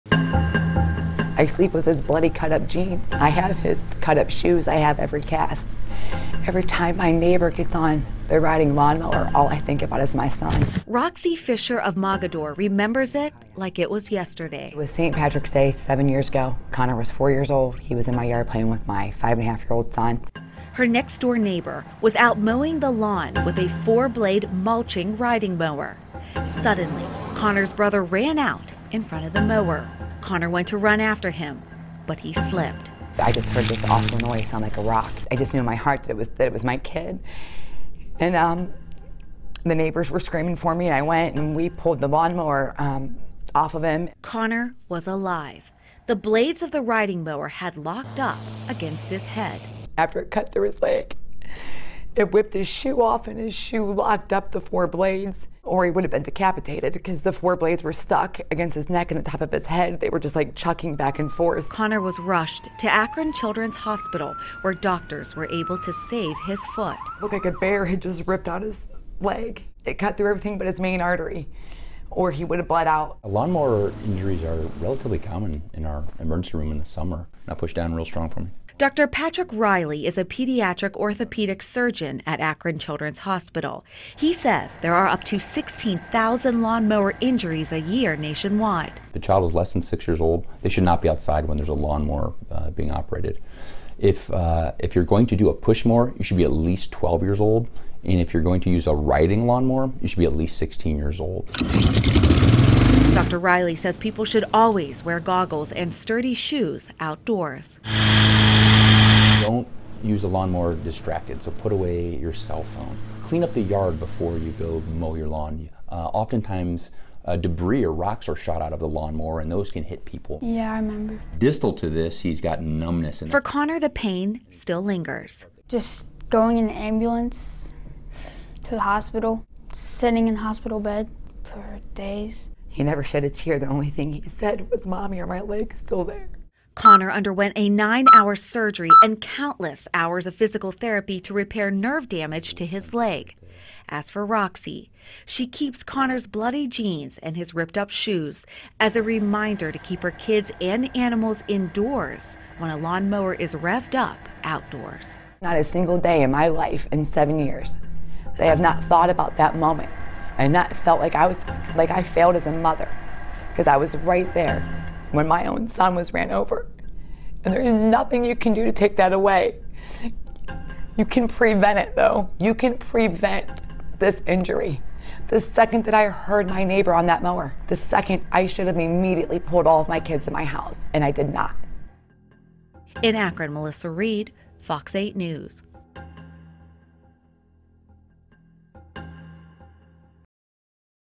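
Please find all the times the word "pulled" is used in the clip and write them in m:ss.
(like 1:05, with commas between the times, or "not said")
0:41, 2:59.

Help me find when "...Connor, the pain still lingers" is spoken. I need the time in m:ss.
2:03.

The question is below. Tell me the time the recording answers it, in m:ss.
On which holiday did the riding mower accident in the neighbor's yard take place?
0:14.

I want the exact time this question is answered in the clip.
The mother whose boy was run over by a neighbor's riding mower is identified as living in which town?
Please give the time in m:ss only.
0:11.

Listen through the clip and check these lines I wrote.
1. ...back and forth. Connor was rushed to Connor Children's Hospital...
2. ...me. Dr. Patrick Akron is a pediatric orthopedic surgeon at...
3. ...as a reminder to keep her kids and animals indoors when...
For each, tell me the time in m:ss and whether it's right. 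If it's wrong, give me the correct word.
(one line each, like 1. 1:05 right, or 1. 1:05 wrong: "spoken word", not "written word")
1. 1:00 wrong: "Akron", not "Connor"
2. 1:18 wrong: "Riley", not "Akron"
3. 2:28 right.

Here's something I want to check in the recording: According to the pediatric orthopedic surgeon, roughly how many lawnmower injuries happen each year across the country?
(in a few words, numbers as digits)
16,000.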